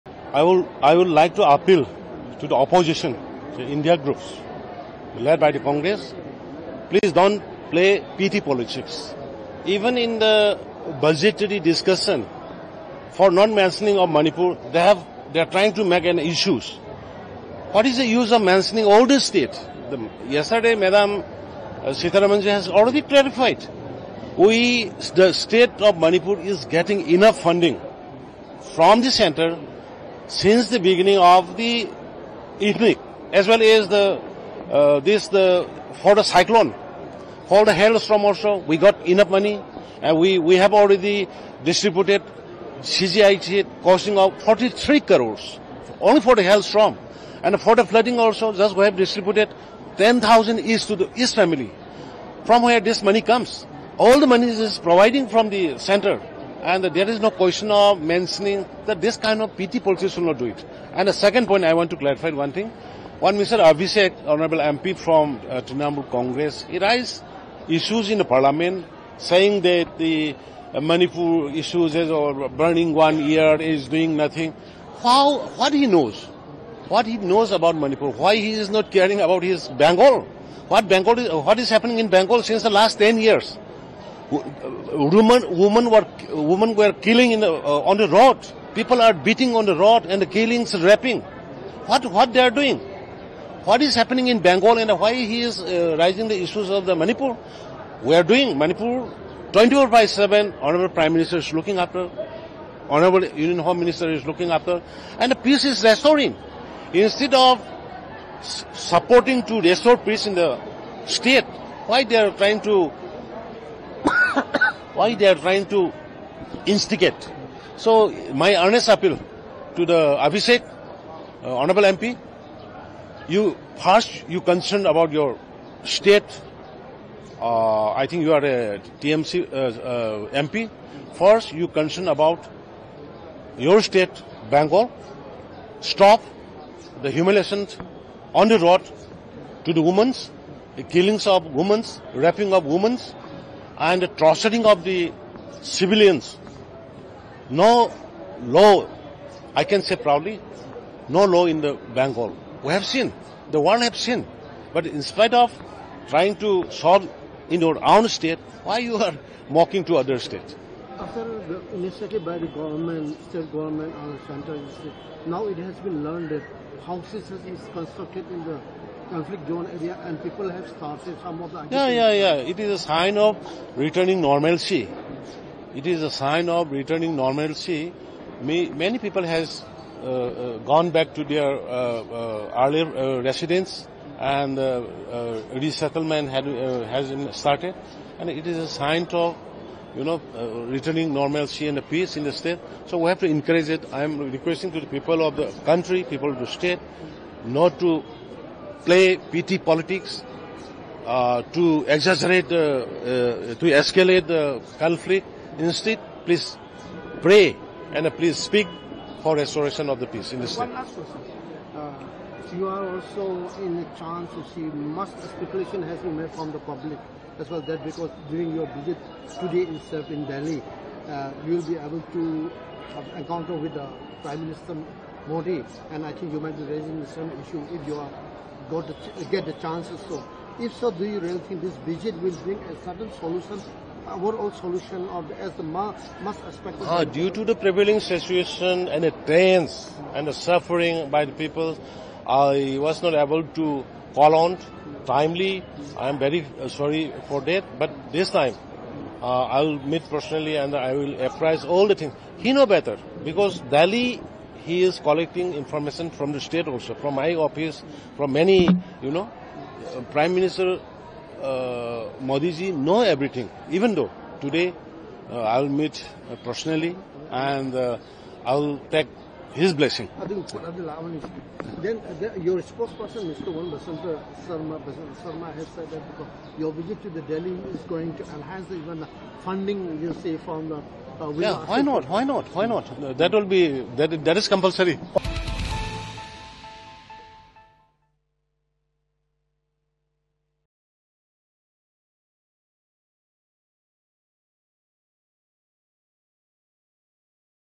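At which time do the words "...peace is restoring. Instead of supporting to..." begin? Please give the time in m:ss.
1:45.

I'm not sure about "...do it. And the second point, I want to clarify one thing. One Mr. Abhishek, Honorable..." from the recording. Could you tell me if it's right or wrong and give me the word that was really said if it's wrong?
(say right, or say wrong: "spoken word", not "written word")
right.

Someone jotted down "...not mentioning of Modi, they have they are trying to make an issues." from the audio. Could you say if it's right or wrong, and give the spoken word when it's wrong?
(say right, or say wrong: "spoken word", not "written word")
wrong: "Manipur", not "Modi".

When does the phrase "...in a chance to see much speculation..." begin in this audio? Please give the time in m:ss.
3:33.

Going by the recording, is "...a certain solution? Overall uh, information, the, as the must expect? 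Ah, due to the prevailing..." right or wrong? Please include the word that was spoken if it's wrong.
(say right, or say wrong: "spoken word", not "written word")
wrong: "solution", not "information".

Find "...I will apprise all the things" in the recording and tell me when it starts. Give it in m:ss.
4:10.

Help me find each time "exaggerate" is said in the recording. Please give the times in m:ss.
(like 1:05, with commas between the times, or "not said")
3:21.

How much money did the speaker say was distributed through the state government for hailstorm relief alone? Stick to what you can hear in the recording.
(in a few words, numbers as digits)
43 crores.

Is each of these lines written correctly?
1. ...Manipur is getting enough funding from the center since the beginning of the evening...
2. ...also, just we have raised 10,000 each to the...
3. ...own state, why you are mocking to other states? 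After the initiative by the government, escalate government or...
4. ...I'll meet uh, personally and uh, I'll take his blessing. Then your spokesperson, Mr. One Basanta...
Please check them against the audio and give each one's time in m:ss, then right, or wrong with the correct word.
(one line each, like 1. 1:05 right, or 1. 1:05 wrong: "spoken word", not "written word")
1. 0:25 right
2. 0:48 wrong: "distributed", not "raised"
3. 2:37 wrong: "state", not "escalate"
4. 4:25 right.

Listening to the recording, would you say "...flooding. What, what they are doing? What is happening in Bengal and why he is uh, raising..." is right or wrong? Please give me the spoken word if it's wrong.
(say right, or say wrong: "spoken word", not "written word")
wrong: "raping", not "flooding".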